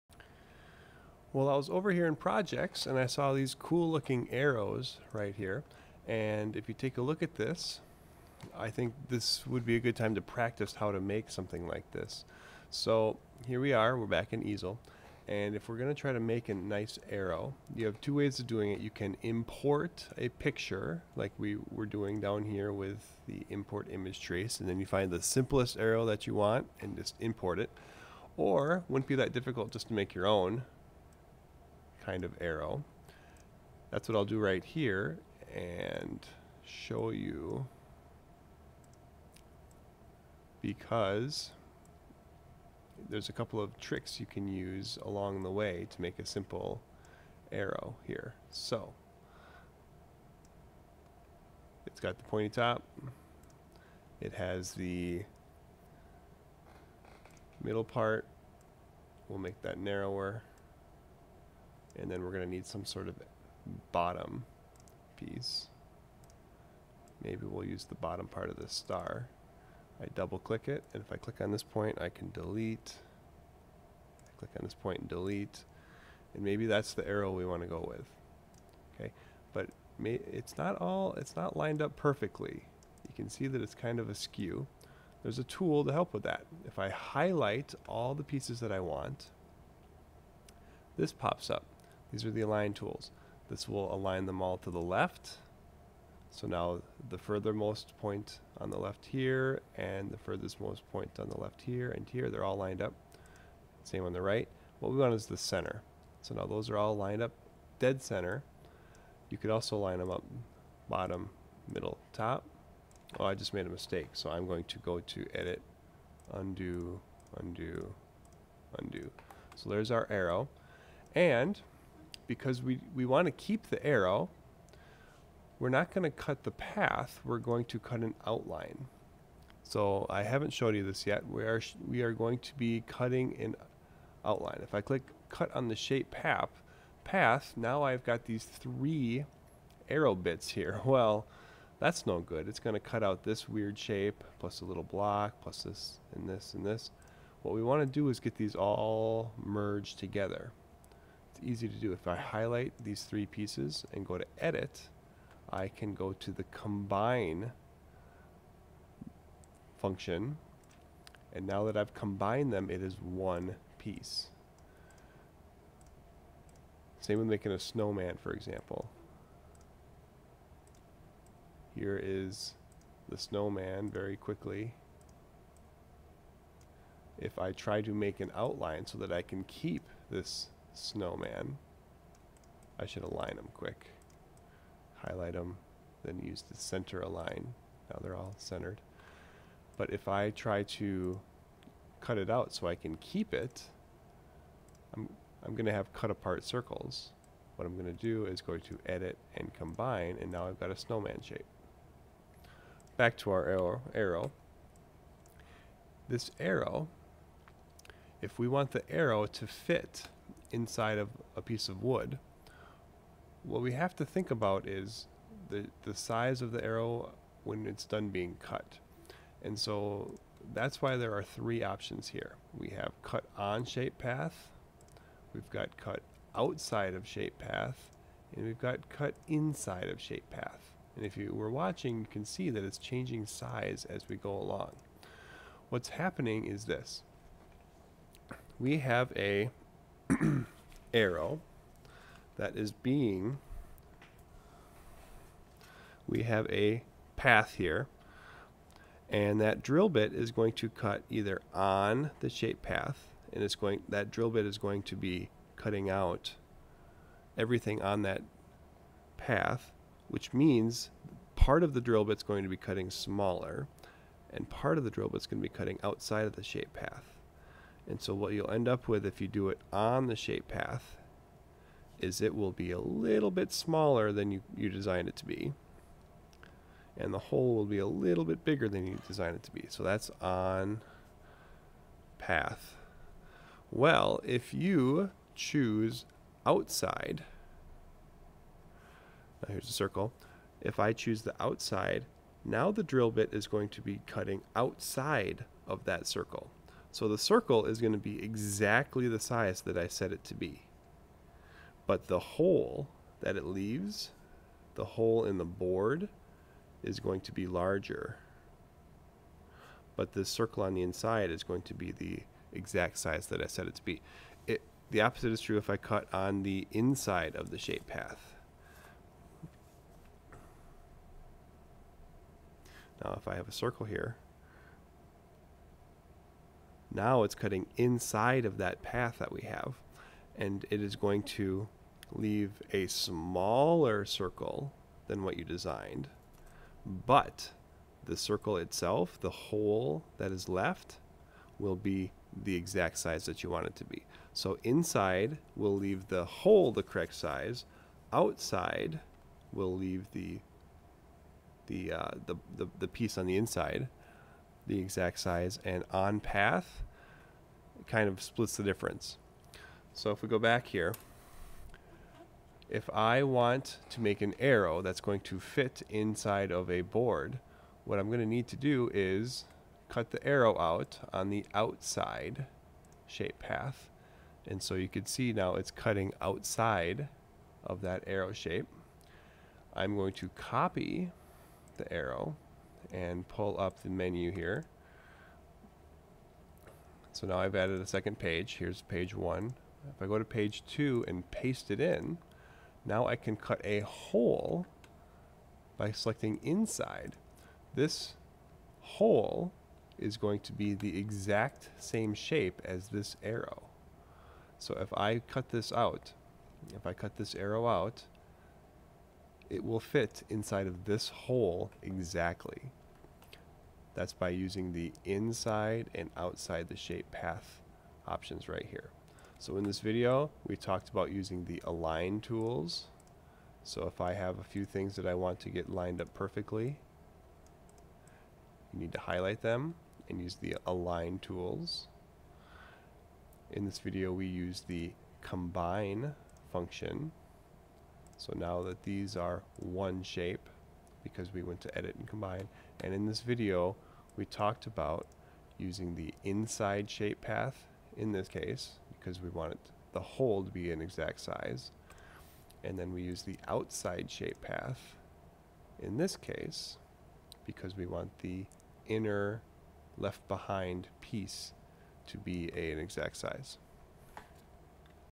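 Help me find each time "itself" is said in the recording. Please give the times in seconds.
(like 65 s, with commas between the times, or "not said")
338 s.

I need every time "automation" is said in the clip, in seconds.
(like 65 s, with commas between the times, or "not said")
not said.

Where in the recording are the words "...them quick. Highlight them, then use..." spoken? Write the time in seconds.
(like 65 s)
183 s.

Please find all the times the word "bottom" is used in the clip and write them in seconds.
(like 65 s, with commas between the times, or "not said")
63 s, 67 s, 110 s.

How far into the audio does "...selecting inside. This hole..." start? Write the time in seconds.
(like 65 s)
395 s.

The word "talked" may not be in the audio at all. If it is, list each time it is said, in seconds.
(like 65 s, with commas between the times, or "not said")
420 s, 444 s.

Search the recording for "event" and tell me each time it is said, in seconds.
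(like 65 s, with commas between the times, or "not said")
not said.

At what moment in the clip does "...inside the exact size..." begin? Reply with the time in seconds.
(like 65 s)
353 s.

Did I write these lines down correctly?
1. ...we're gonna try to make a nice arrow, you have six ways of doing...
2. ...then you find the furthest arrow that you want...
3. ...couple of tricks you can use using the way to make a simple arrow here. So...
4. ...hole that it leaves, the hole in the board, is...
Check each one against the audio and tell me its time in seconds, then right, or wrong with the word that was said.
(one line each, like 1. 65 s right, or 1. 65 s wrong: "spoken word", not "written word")
1. 15 s wrong: "two", not "six"
2. 24 s wrong: "simplest", not "furthest"
3. 43 s wrong: "along", not "using"
4. 302 s right.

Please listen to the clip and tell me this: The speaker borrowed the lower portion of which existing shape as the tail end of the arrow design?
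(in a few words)
Star.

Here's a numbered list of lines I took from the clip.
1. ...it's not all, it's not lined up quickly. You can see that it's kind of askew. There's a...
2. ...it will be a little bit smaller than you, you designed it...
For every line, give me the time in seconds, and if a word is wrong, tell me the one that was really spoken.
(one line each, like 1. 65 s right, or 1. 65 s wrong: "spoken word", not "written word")
1. 80 s wrong: "perfectly", not "quickly"
2. 272 s right.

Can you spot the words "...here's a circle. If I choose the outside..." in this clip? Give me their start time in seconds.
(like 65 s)
289 s.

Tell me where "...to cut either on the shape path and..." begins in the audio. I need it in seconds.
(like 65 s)
250 s.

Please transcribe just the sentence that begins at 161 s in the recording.
And now that I've combined them, it is one piece.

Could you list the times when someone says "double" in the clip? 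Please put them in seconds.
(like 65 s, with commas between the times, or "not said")
70 s.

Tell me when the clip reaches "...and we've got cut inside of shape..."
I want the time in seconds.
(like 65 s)
228 s.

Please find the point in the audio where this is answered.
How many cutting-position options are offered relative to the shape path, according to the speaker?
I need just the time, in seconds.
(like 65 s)
221 s.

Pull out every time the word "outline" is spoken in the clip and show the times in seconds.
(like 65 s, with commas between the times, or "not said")
128 s, 134 s, 178 s.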